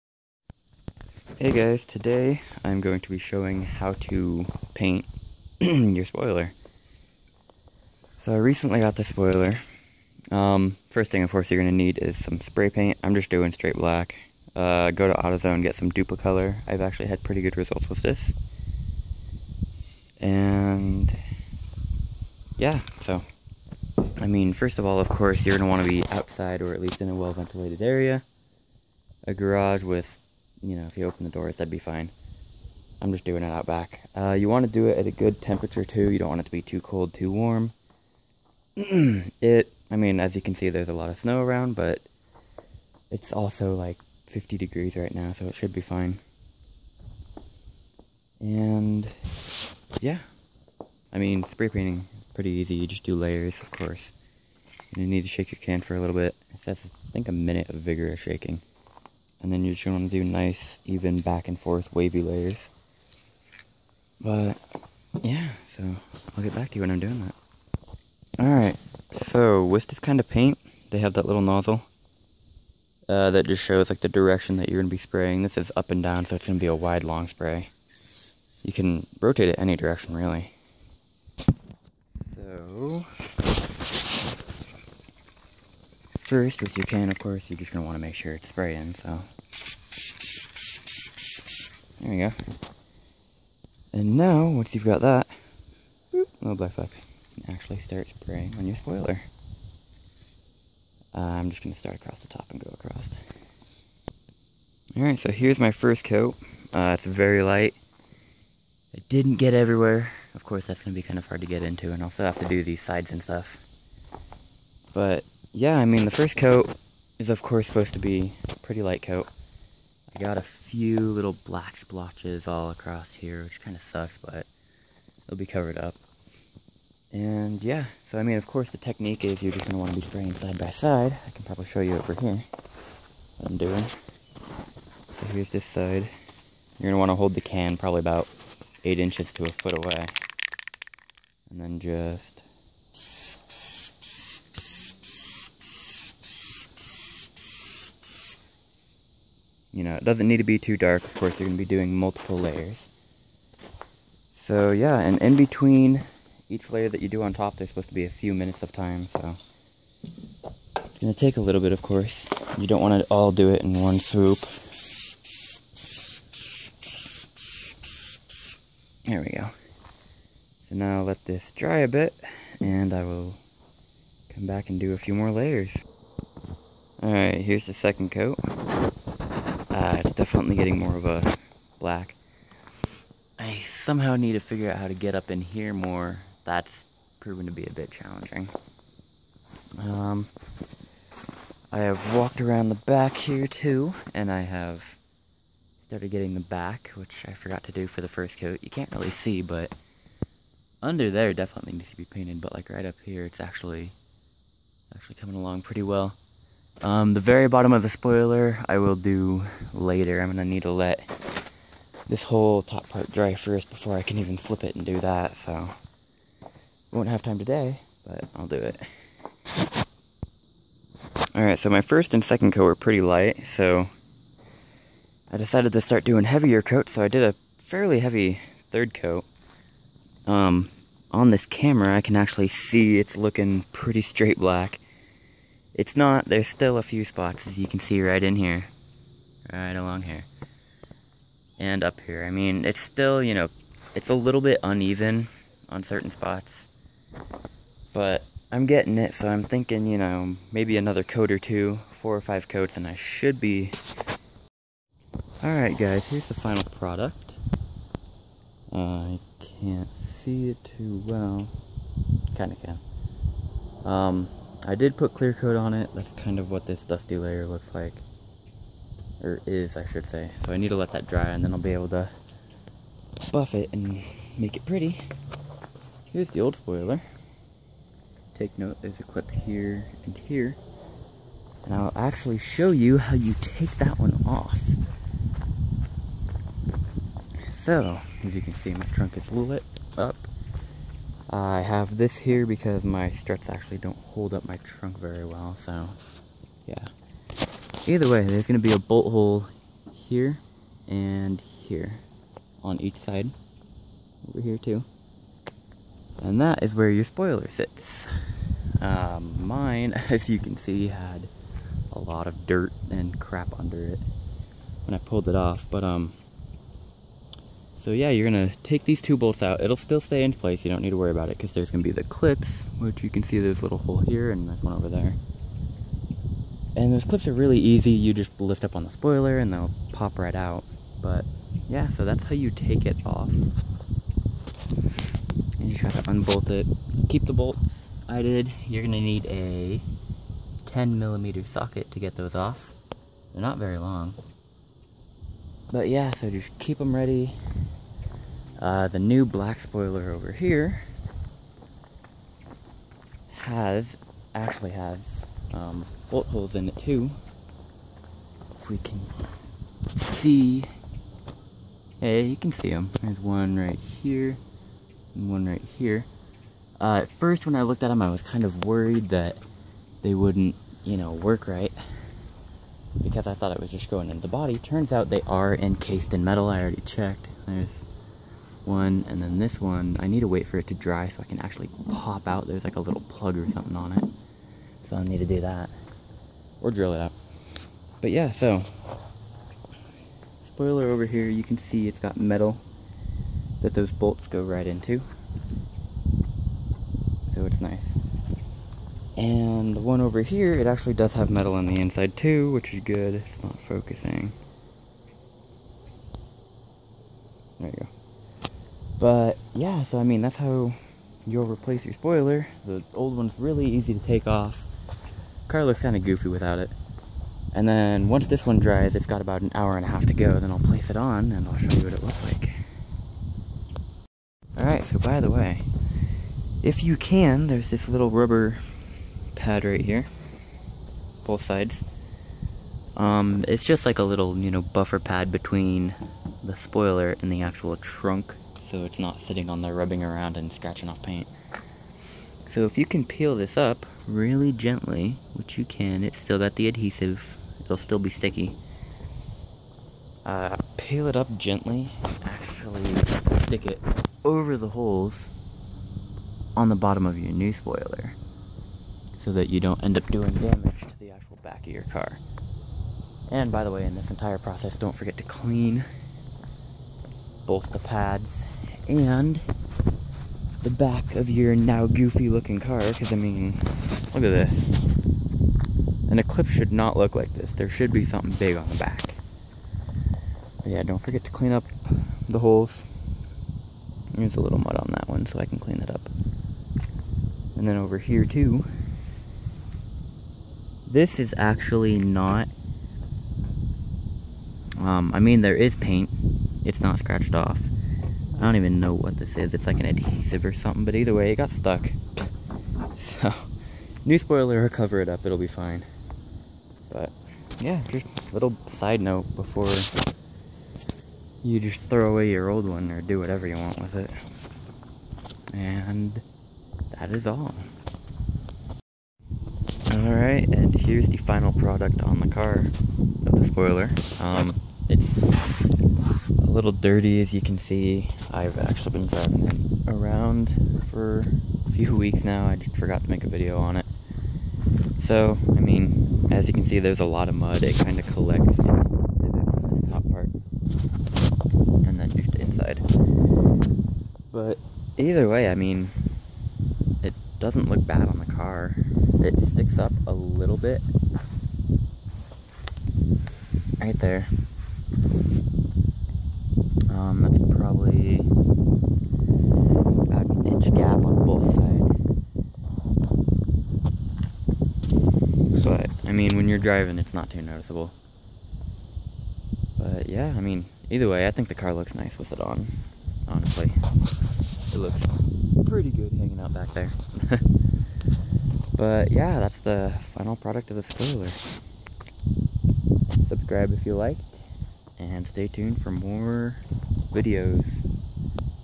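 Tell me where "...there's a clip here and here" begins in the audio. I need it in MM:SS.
04:38.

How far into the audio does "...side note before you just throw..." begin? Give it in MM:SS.
08:28.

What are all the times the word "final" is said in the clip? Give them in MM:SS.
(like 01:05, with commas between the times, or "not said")
04:16, 08:41, 09:40.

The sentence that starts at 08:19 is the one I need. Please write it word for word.
It's like an adhesive or something, but either way, it got stuck.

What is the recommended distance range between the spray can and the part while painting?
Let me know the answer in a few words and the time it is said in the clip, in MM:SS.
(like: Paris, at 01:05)
8 inches to a foot, at 02:18.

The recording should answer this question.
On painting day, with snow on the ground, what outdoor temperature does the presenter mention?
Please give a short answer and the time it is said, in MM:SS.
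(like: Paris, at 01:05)
50 degrees, at 00:44.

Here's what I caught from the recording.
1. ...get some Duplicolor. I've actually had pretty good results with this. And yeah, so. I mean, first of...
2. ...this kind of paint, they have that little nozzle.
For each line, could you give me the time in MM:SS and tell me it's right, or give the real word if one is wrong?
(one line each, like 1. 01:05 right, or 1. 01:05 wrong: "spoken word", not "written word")
1. 00:15 right
2. 01:09 right.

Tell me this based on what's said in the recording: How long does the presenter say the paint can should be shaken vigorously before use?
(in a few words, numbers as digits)
a minute.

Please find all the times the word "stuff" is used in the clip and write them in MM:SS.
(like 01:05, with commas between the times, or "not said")
01:53.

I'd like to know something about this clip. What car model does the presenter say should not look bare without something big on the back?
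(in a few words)
Eclipse.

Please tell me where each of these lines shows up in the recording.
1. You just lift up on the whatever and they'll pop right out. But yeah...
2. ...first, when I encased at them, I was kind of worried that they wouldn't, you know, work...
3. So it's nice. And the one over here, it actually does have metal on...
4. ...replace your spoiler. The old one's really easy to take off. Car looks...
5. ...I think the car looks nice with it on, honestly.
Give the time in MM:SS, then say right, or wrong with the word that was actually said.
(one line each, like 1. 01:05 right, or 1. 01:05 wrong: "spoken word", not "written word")
1. 05:27 wrong: "spoiler", not "whatever"
2. 06:07 wrong: "looked", not "encased"
3. 06:37 right
4. 06:51 right
5. 09:31 right.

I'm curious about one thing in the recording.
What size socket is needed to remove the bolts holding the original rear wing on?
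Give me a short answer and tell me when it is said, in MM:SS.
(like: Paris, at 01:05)
10 millimeter, at 05:40.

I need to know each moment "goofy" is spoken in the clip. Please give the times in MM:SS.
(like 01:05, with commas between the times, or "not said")
06:56, 07:51.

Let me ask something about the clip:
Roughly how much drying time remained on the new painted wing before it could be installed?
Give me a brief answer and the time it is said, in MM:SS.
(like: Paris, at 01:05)
an hour and a half, at 06:59.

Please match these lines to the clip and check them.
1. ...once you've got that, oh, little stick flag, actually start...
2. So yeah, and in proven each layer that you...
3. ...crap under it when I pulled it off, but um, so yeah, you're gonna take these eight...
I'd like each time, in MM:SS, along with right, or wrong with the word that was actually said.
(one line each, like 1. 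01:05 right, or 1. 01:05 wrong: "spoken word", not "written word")
1. 01:34 wrong: "black", not "stick"
2. 02:34 wrong: "between", not "proven"
3. 05:13 wrong: "two", not "eight".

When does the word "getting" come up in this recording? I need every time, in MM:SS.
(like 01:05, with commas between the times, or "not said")
03:00, 03:16, 04:08.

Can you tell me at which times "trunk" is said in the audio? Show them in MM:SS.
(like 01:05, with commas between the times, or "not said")
04:48, 04:54, 07:17.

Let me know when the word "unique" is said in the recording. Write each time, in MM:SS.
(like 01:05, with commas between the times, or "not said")
not said.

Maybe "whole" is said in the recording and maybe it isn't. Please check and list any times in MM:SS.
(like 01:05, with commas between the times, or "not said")
03:32.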